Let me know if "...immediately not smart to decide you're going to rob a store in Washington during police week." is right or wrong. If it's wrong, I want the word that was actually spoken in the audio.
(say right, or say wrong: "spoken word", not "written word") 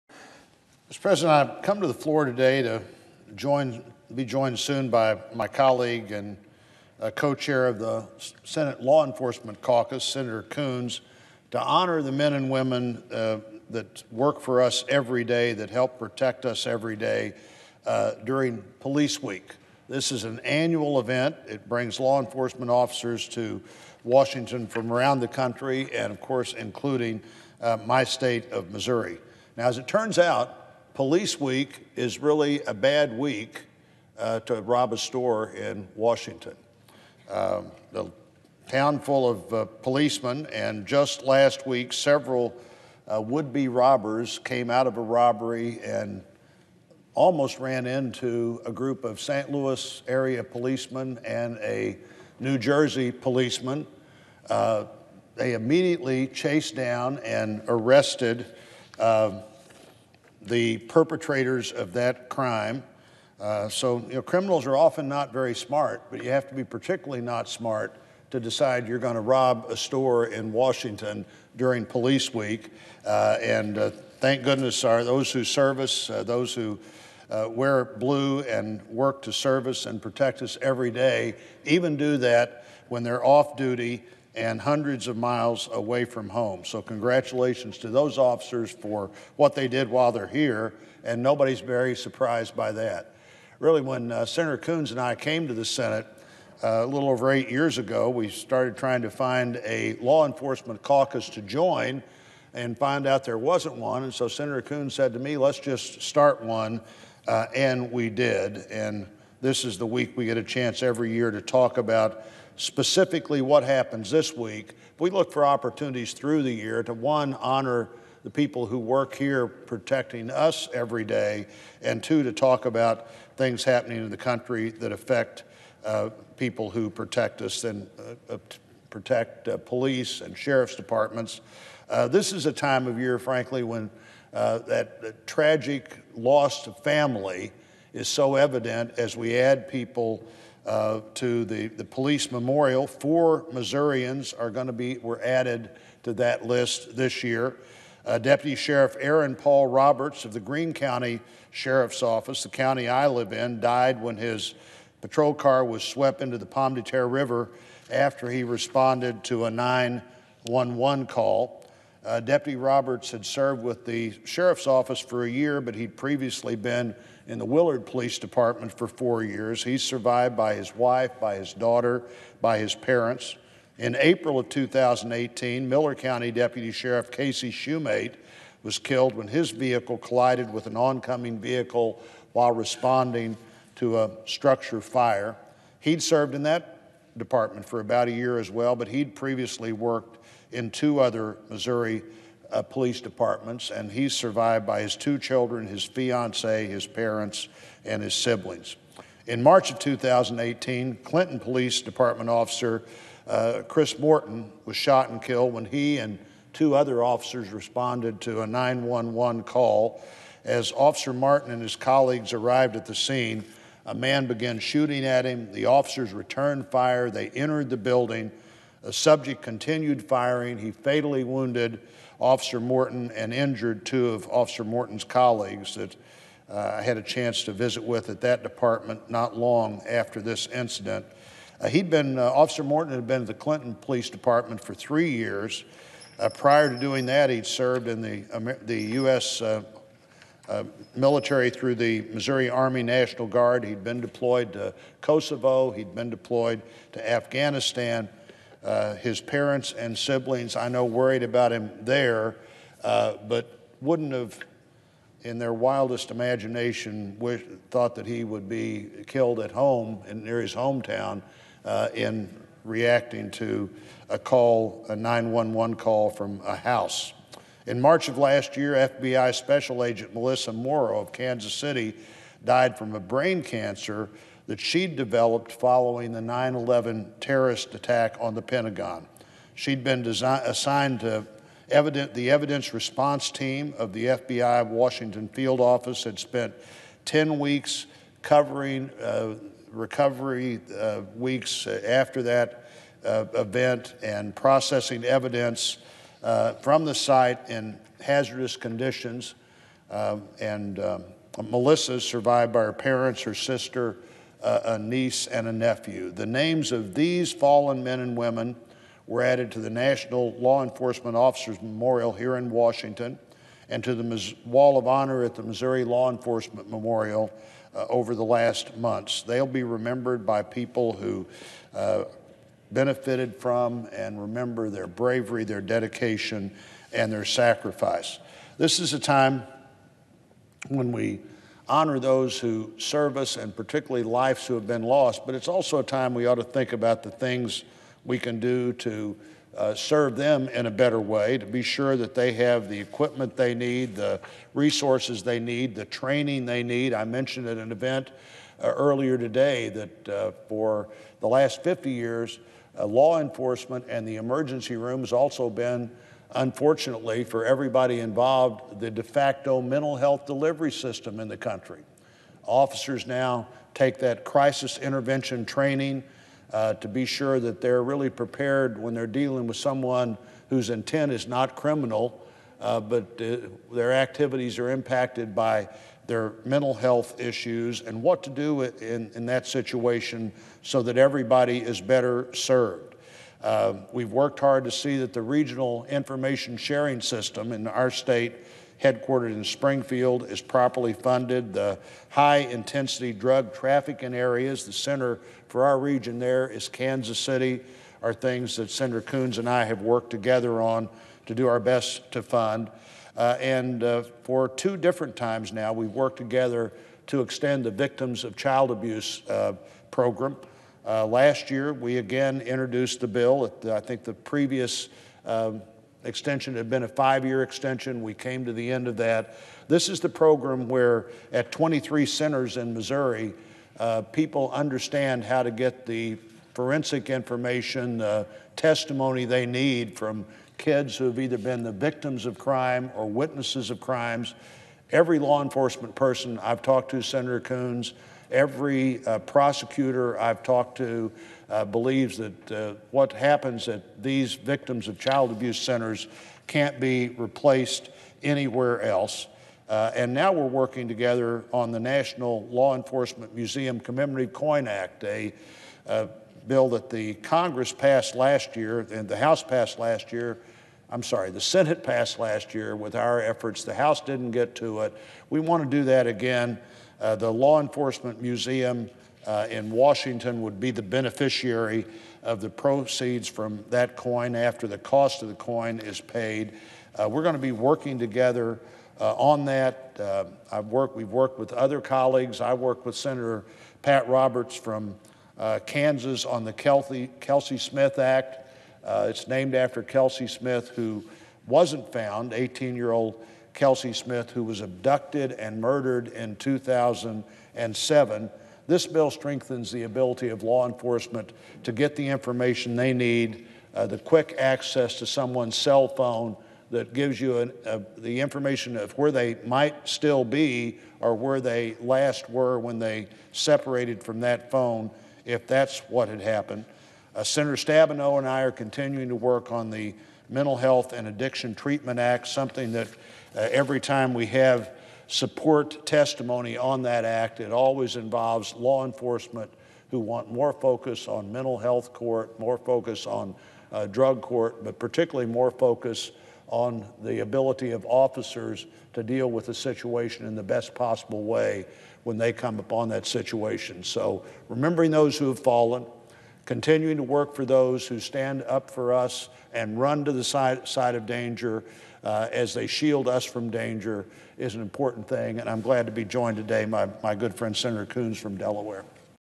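wrong: "particularly", not "immediately".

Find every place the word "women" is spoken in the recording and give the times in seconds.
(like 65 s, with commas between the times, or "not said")
12 s, 308 s.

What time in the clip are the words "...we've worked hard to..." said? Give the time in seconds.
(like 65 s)
383 s.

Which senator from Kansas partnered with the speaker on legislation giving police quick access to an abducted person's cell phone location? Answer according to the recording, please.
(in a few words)
Pat Roberts.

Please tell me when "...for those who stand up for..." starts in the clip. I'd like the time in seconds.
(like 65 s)
547 s.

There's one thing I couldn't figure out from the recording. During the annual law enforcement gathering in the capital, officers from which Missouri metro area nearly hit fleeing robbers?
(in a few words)
St. Louis.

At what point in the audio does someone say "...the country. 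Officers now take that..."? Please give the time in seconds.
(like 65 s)
361 s.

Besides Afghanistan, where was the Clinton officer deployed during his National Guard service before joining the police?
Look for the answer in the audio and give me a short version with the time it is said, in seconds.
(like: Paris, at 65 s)
Kosovo, at 244 s.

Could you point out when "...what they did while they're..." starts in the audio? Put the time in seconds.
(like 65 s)
89 s.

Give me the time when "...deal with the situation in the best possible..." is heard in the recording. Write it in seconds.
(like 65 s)
539 s.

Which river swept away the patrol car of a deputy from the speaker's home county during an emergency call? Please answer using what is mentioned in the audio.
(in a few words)
Pomme de Terre River.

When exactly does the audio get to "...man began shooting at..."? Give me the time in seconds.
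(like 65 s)
213 s.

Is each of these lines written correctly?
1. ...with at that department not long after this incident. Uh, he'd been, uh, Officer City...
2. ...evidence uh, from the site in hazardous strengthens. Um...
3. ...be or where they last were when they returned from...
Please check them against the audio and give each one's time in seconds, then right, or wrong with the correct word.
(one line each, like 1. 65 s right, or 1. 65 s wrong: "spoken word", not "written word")
1. 227 s wrong: "Morton", not "City"
2. 295 s wrong: "conditions", not "strengthens"
3. 510 s wrong: "separated", not "returned".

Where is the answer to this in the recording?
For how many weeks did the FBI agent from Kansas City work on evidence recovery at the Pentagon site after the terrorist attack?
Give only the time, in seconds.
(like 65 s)
287 s.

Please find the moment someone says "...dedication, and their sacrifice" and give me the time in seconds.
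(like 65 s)
325 s.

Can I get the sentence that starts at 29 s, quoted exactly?
Now, as it turns out, Police Week is really a bad week uh, to rob a store in Washington.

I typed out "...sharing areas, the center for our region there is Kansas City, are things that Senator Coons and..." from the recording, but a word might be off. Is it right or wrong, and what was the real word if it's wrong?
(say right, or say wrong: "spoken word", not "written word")
wrong: "trafficking", not "sharing".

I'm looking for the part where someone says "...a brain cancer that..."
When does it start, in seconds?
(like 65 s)
272 s.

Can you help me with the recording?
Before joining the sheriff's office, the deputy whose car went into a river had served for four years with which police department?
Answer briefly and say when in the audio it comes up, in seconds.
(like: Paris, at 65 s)
Willard Police Department, at 167 s.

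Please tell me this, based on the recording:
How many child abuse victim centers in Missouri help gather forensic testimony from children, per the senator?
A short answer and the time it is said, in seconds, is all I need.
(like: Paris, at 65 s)
23, at 421 s.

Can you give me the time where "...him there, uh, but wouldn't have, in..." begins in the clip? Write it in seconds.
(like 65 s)
251 s.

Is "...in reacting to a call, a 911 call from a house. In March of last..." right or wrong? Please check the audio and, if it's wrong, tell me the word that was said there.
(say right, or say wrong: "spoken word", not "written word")
right.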